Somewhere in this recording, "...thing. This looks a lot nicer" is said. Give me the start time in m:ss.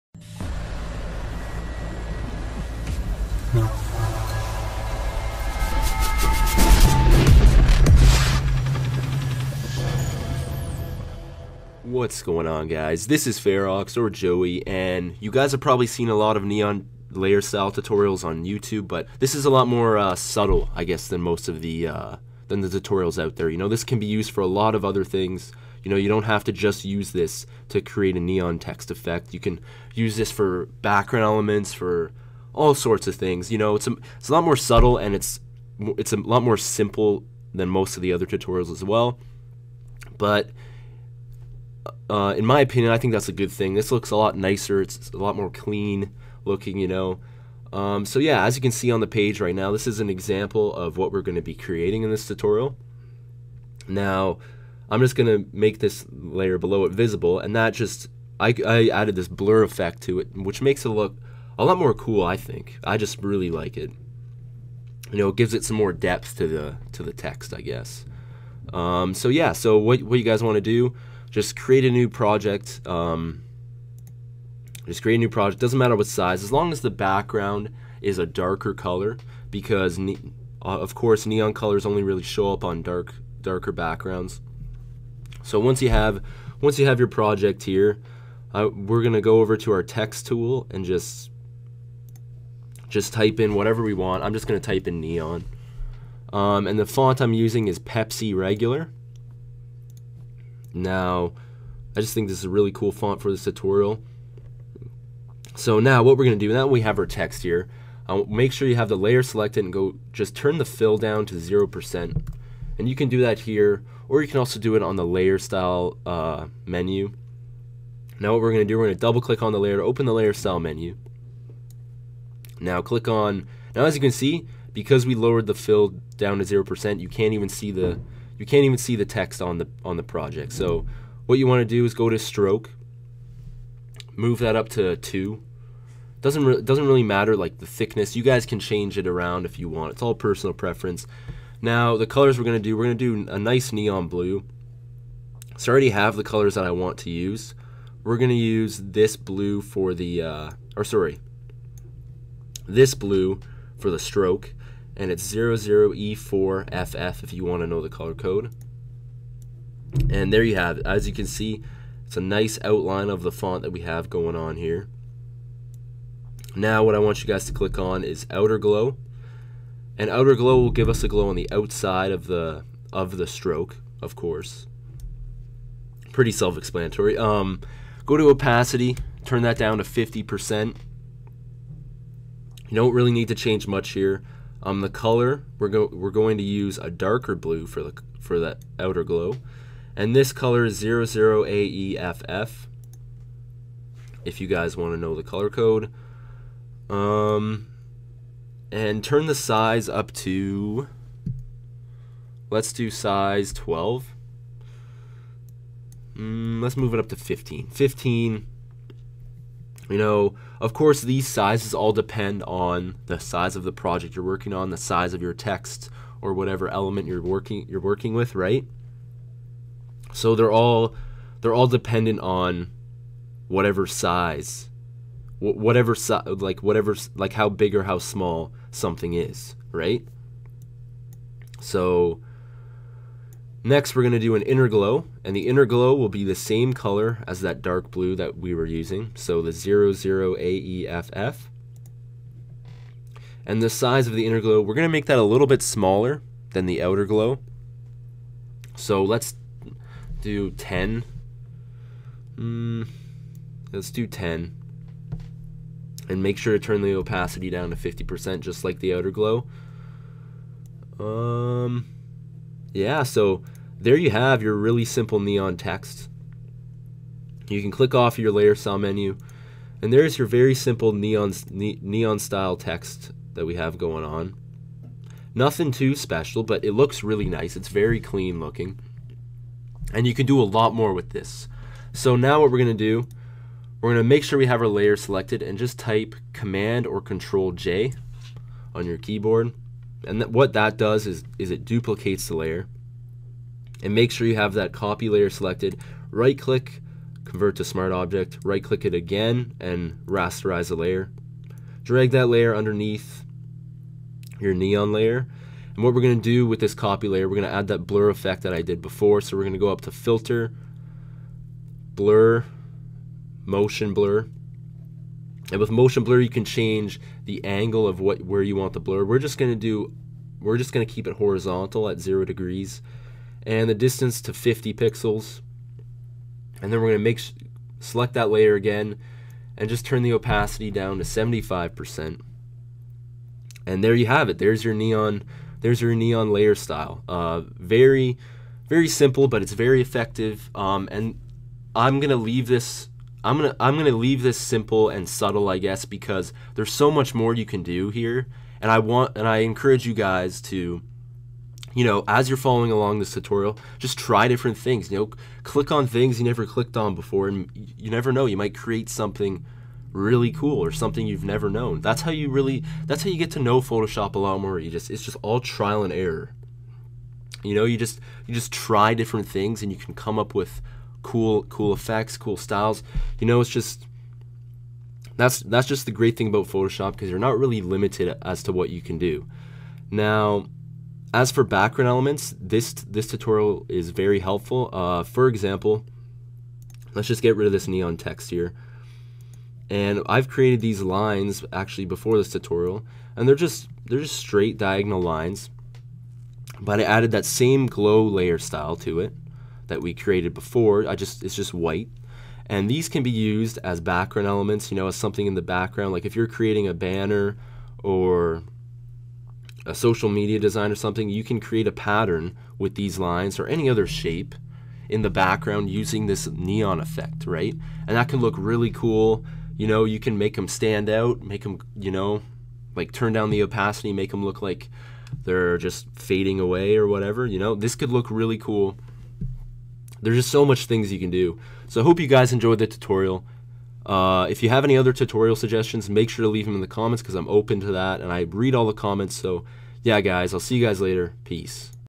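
0:43.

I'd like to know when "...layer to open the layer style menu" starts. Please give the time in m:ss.
1:59.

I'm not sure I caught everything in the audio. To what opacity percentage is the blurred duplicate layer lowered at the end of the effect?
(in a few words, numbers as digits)
75%.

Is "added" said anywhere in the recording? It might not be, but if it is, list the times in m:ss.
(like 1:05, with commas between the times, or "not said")
0:58, 6:36.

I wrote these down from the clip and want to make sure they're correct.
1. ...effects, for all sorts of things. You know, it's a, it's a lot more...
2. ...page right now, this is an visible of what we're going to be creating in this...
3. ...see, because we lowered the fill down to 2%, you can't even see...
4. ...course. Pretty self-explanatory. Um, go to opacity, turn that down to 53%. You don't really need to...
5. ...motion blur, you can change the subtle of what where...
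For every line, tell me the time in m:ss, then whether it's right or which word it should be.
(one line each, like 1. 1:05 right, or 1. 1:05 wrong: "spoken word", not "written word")
1. 0:31 wrong: "elements", not "effects"
2. 0:49 wrong: "example", not "visible"
3. 2:04 wrong: "0", not "2"
4. 2:54 wrong: "50", not "53"
5. 5:15 wrong: "angle", not "subtle".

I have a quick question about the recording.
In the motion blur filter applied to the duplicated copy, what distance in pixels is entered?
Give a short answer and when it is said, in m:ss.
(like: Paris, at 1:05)
50 pixels, at 5:24.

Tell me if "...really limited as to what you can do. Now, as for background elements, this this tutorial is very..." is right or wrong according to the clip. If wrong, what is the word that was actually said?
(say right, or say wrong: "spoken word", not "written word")
right.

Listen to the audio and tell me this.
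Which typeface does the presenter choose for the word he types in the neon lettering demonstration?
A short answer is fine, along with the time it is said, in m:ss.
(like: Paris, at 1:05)
Pepsi Regular, at 1:37.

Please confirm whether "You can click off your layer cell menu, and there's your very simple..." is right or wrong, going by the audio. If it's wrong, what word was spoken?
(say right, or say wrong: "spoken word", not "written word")
right.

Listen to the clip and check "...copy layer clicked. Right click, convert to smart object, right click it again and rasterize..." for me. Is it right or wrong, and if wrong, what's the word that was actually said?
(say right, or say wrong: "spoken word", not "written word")
wrong: "selected", not "clicked".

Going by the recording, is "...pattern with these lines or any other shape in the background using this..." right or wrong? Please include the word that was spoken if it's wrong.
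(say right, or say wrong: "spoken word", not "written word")
right.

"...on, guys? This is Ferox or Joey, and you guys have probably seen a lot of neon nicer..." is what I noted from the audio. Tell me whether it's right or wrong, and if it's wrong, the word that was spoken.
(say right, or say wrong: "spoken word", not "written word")
wrong: "layer", not "nicer".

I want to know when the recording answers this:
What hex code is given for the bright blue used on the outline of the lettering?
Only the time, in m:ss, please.
2:35.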